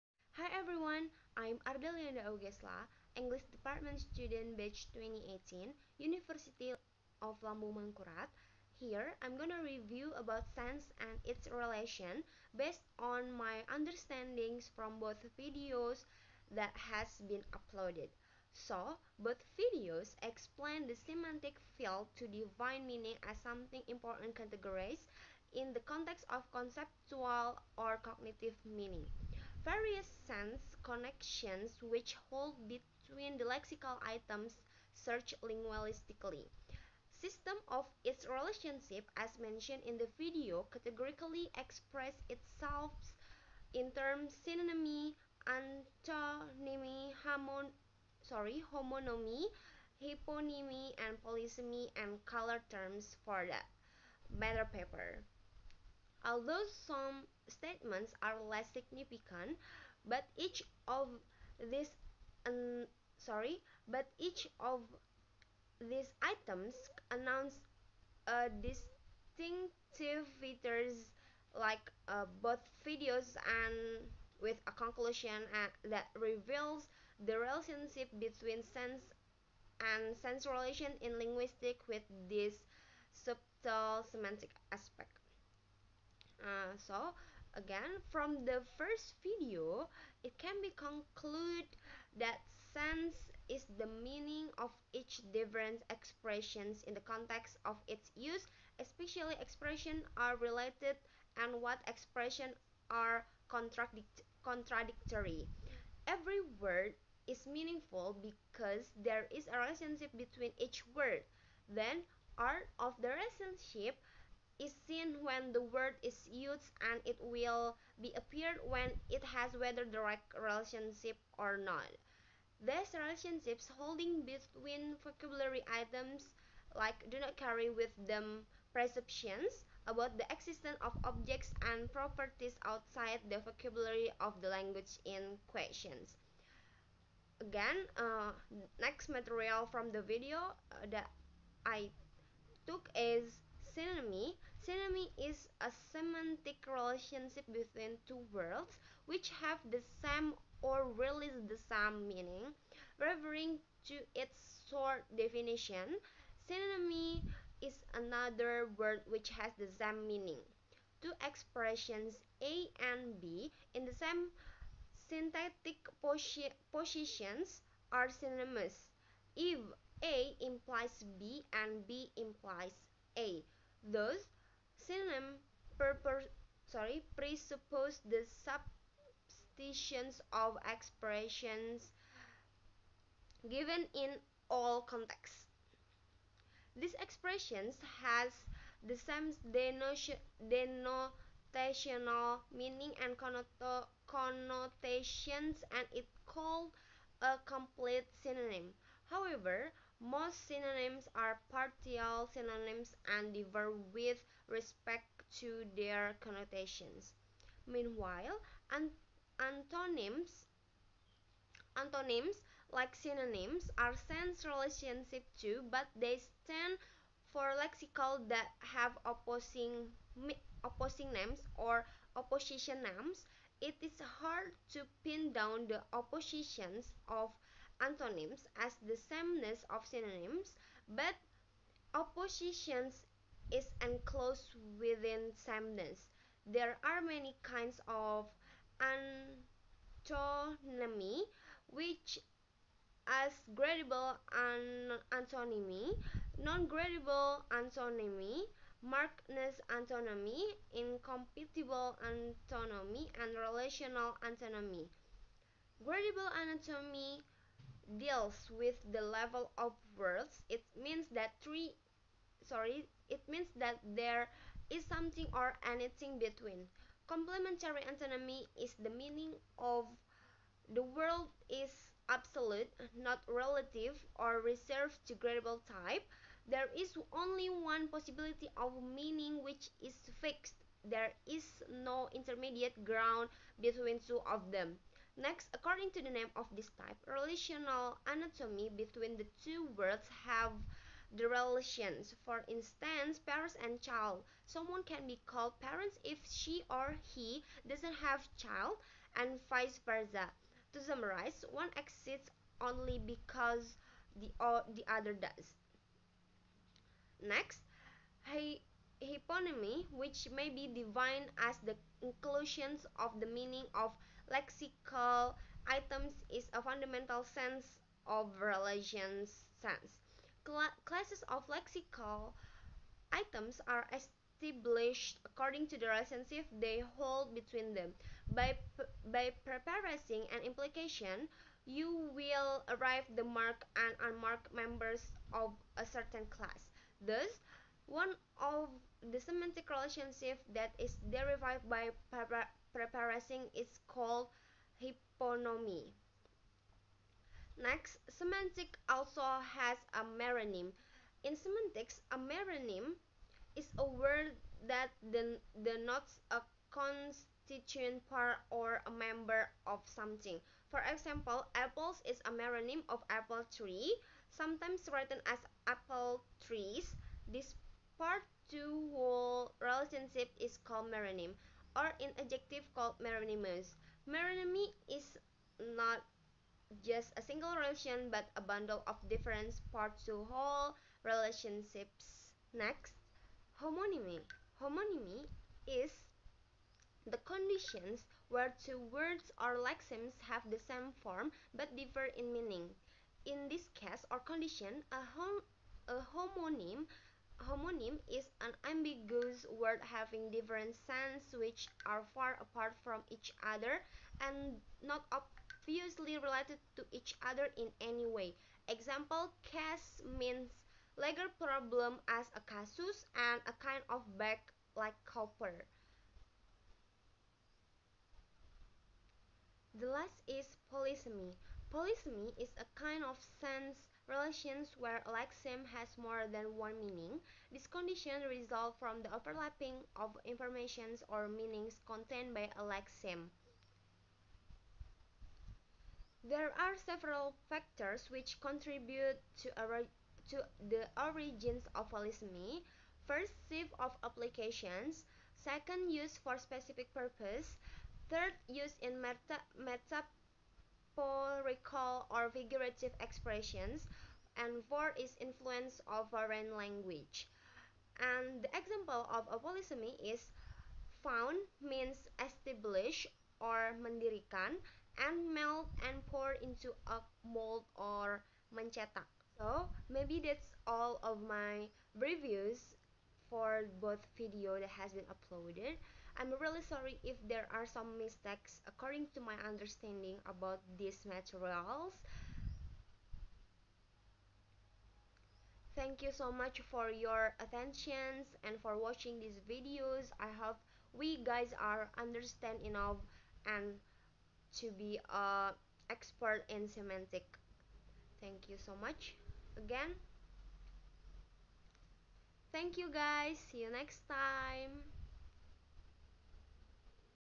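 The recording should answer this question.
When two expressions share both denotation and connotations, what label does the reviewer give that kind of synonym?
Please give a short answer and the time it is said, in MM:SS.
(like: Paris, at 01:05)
complete synonym, at 03:17.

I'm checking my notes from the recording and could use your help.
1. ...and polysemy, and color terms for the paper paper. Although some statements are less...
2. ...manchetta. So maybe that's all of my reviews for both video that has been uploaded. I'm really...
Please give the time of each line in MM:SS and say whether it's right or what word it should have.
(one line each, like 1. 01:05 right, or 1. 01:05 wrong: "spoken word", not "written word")
1. 00:51 wrong: "matter", not "paper"
2. 07:48 right.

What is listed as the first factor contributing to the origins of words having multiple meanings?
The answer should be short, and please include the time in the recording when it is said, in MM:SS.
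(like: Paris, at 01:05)
shift of applications, at 07:23.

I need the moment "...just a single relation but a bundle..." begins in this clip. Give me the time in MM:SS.
06:16.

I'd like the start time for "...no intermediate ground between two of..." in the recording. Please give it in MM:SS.
04:41.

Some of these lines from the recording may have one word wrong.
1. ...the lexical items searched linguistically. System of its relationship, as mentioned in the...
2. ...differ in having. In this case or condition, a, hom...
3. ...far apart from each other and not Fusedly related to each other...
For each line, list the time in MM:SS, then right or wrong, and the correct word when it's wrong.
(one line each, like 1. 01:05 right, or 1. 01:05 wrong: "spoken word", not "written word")
1. 00:33 right
2. 06:31 wrong: "meaning", not "having"
3. 06:42 right.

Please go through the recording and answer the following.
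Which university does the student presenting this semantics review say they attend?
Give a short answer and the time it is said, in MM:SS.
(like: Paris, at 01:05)
University of Lambung Mangkurat, at 00:05.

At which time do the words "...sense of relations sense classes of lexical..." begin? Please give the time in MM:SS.
05:17.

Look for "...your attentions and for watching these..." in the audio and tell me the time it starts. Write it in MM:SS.
08:06.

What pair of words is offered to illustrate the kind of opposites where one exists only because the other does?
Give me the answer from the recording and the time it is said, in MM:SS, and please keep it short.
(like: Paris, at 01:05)
parents and child, at 04:53.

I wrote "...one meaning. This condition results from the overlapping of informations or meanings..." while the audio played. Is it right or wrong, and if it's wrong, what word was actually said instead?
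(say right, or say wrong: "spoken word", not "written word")
right.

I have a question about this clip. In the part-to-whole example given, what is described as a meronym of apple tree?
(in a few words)
apples.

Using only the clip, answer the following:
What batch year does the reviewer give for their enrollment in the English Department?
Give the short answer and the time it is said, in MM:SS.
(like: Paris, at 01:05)
2018, at 00:04.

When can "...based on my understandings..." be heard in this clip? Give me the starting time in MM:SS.
00:12.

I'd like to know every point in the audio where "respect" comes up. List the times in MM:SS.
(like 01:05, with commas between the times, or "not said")
03:24.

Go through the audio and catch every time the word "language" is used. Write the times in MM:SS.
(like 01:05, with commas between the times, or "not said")
02:14, 07:36.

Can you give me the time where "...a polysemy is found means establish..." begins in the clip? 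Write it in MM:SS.
07:39.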